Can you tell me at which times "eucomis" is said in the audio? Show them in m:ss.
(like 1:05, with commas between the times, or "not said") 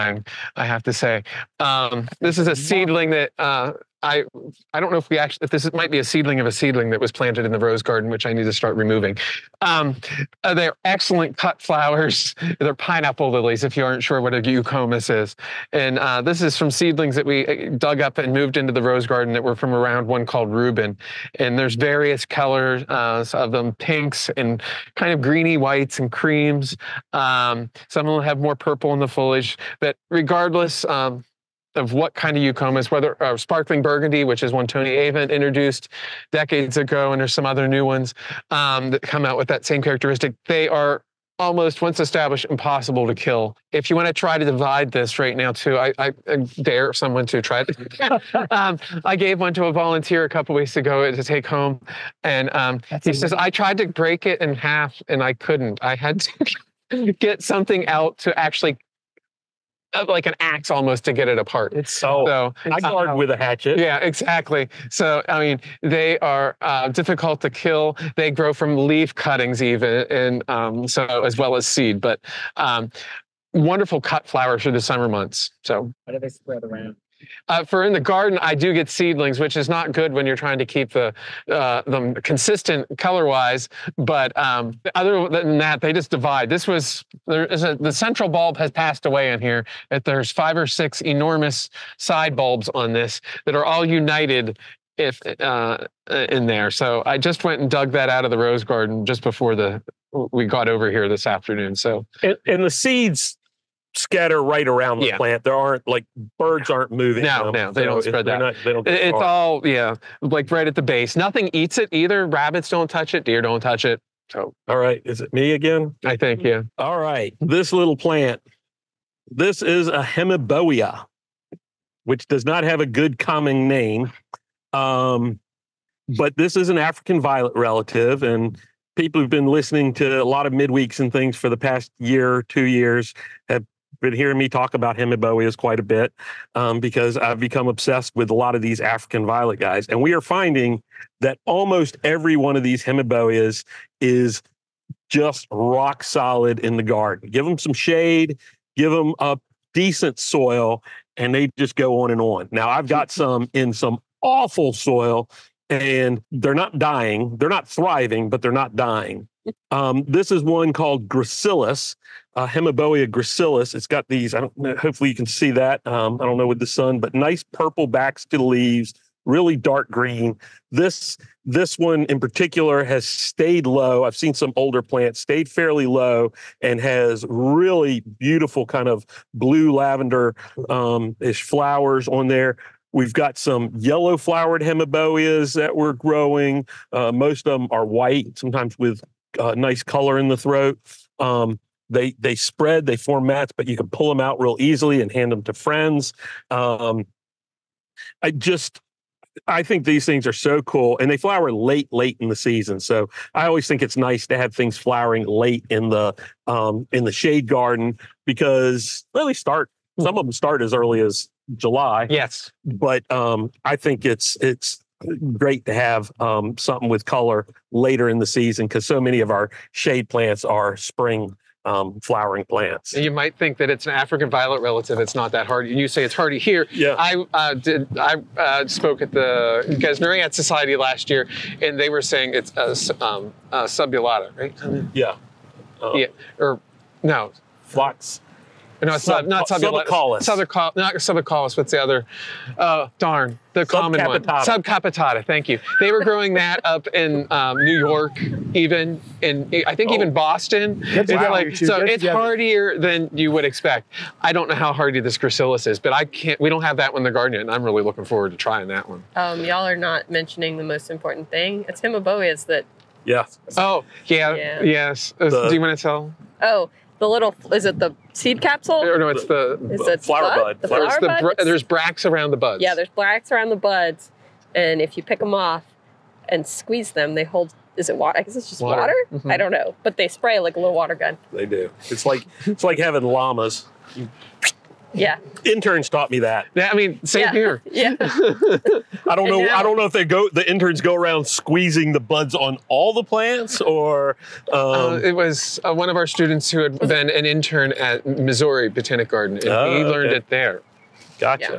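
0:14, 0:32.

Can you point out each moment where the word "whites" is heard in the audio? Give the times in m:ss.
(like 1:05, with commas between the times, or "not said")
0:25, 3:07.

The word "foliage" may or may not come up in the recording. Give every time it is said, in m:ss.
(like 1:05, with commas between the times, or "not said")
0:29.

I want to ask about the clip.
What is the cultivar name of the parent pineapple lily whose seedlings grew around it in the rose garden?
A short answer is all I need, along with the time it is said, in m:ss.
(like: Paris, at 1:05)
Reuben, at 0:20.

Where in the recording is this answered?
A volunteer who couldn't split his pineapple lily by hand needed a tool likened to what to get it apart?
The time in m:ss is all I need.
1:00.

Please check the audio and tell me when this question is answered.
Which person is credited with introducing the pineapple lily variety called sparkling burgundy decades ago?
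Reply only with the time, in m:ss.
0:34.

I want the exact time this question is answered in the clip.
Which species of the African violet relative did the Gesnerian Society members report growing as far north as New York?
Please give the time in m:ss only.
4:04.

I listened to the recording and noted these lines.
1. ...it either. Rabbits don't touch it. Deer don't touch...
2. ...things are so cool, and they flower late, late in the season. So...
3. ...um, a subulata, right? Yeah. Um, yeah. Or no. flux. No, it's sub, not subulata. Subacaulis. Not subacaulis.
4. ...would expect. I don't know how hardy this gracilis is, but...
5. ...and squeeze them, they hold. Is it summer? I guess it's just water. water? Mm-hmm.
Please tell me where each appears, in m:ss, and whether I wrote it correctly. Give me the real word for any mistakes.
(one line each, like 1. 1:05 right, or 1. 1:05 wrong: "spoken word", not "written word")
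1. 1:51 right
2. 3:20 right
3. 3:53 right
4. 4:13 right
5. 4:36 wrong: "water", not "summer".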